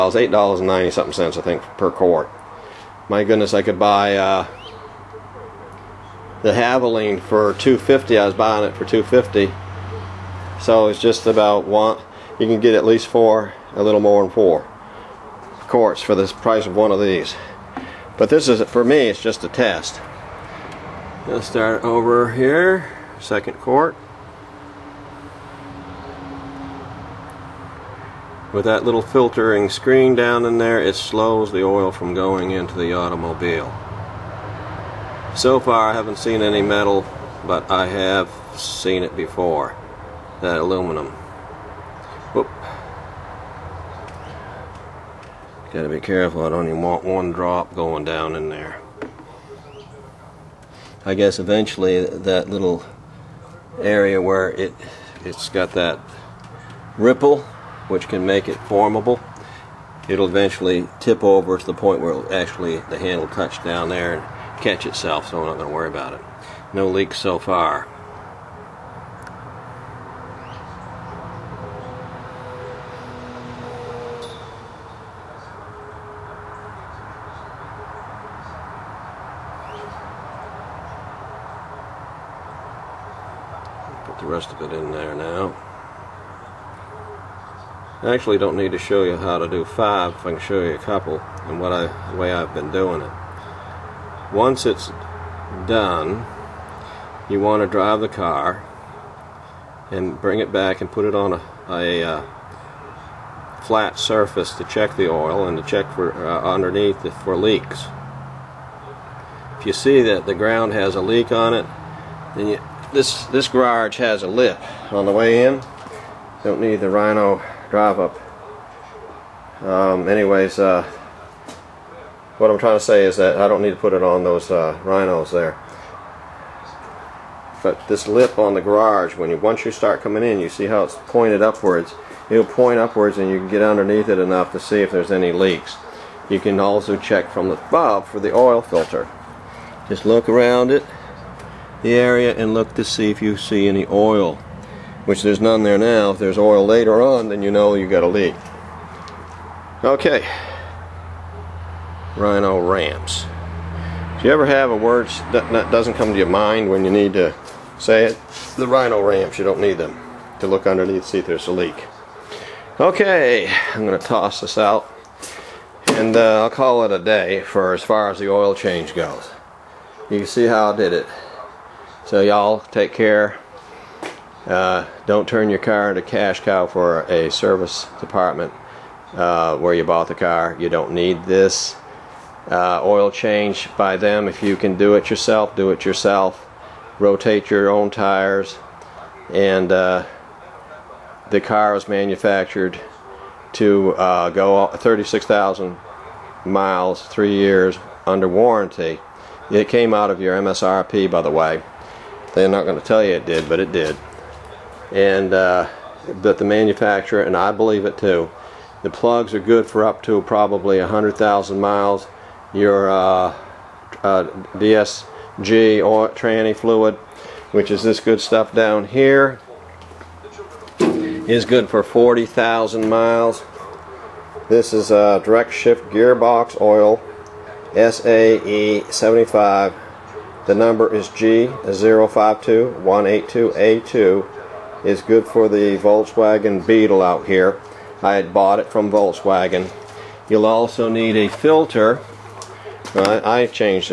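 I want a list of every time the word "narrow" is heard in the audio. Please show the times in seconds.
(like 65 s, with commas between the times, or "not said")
not said.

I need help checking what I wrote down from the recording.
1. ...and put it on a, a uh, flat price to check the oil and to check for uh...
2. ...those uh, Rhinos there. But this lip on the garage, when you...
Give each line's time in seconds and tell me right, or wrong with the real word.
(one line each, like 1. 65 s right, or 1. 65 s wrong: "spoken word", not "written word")
1. 100 s wrong: "surface", not "price"
2. 124 s right.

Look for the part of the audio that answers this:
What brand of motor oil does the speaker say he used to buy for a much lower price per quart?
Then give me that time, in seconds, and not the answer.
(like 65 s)
6 s.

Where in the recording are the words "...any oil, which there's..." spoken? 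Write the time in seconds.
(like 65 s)
143 s.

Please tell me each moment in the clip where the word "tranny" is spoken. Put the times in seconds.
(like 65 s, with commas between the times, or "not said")
216 s.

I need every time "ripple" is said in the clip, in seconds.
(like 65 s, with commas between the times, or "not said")
56 s.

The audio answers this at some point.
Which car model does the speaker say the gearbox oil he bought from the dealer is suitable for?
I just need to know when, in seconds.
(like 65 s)
235 s.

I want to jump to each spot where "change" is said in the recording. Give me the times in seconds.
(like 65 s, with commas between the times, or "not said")
168 s, 183 s.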